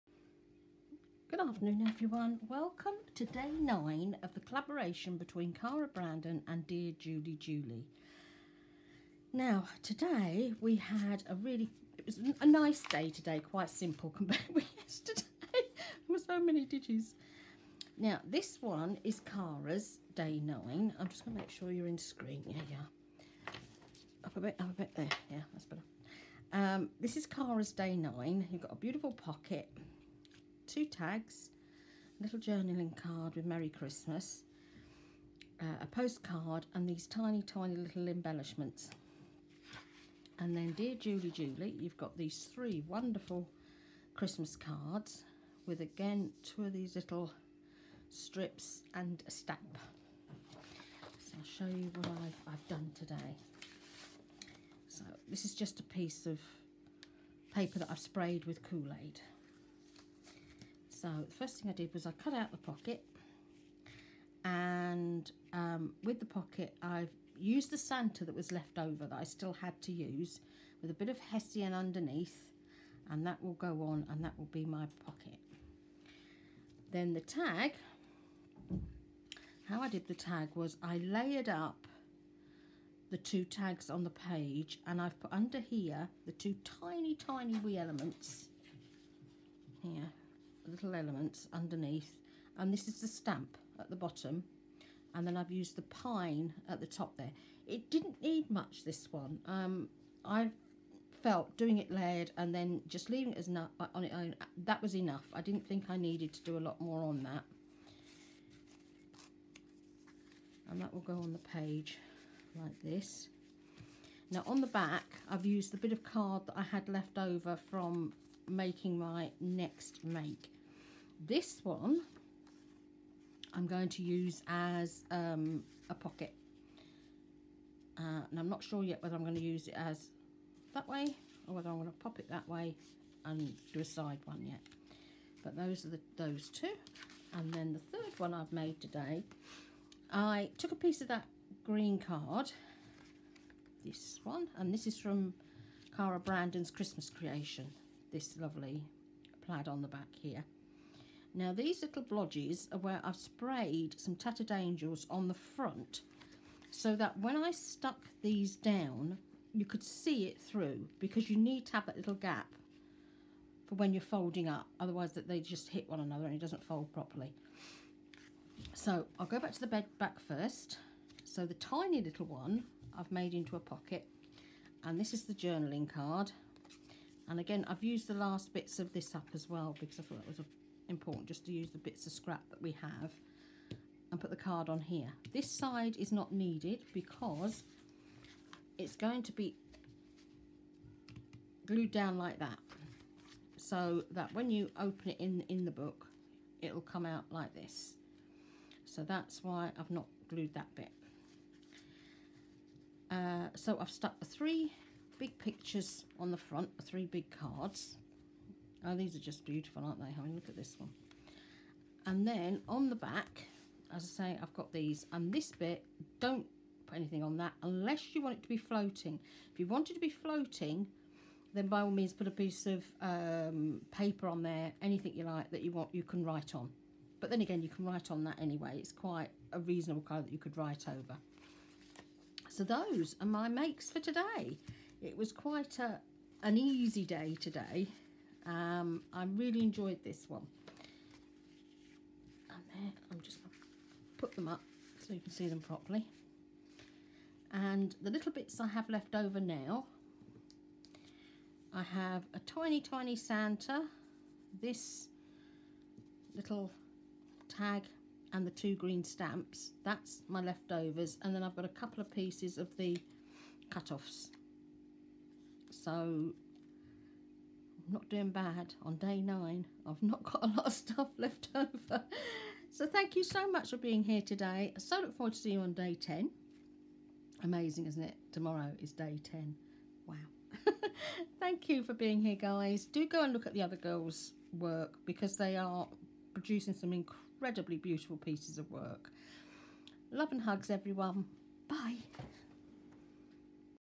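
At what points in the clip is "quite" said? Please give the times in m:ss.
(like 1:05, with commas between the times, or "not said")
0:13, 3:48, 3:55.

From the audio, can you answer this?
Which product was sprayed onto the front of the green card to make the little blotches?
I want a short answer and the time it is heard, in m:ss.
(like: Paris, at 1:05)
tattered angels, at 2:34.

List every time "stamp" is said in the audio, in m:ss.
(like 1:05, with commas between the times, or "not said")
0:49, 1:33, 4:19.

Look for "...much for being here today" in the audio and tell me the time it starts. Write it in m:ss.
4:33.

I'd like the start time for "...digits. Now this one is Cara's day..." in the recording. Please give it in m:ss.
0:16.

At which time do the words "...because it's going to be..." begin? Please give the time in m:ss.
3:06.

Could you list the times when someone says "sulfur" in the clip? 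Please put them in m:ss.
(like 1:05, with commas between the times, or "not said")
not said.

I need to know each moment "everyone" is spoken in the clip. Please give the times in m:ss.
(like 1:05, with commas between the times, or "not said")
0:01, 4:50.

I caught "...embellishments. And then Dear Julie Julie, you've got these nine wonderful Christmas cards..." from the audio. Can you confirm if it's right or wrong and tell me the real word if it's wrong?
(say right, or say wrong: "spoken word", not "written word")
wrong: "three", not "nine".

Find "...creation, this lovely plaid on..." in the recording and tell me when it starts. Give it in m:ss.
2:27.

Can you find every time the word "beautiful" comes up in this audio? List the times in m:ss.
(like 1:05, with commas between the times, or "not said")
0:28, 3:29, 4:47.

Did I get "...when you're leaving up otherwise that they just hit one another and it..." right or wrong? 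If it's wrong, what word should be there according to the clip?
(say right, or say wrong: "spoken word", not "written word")
wrong: "folding", not "leaving".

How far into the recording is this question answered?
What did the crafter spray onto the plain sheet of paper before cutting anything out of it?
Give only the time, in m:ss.
0:58.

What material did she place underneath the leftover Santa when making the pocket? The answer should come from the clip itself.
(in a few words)
Hessian.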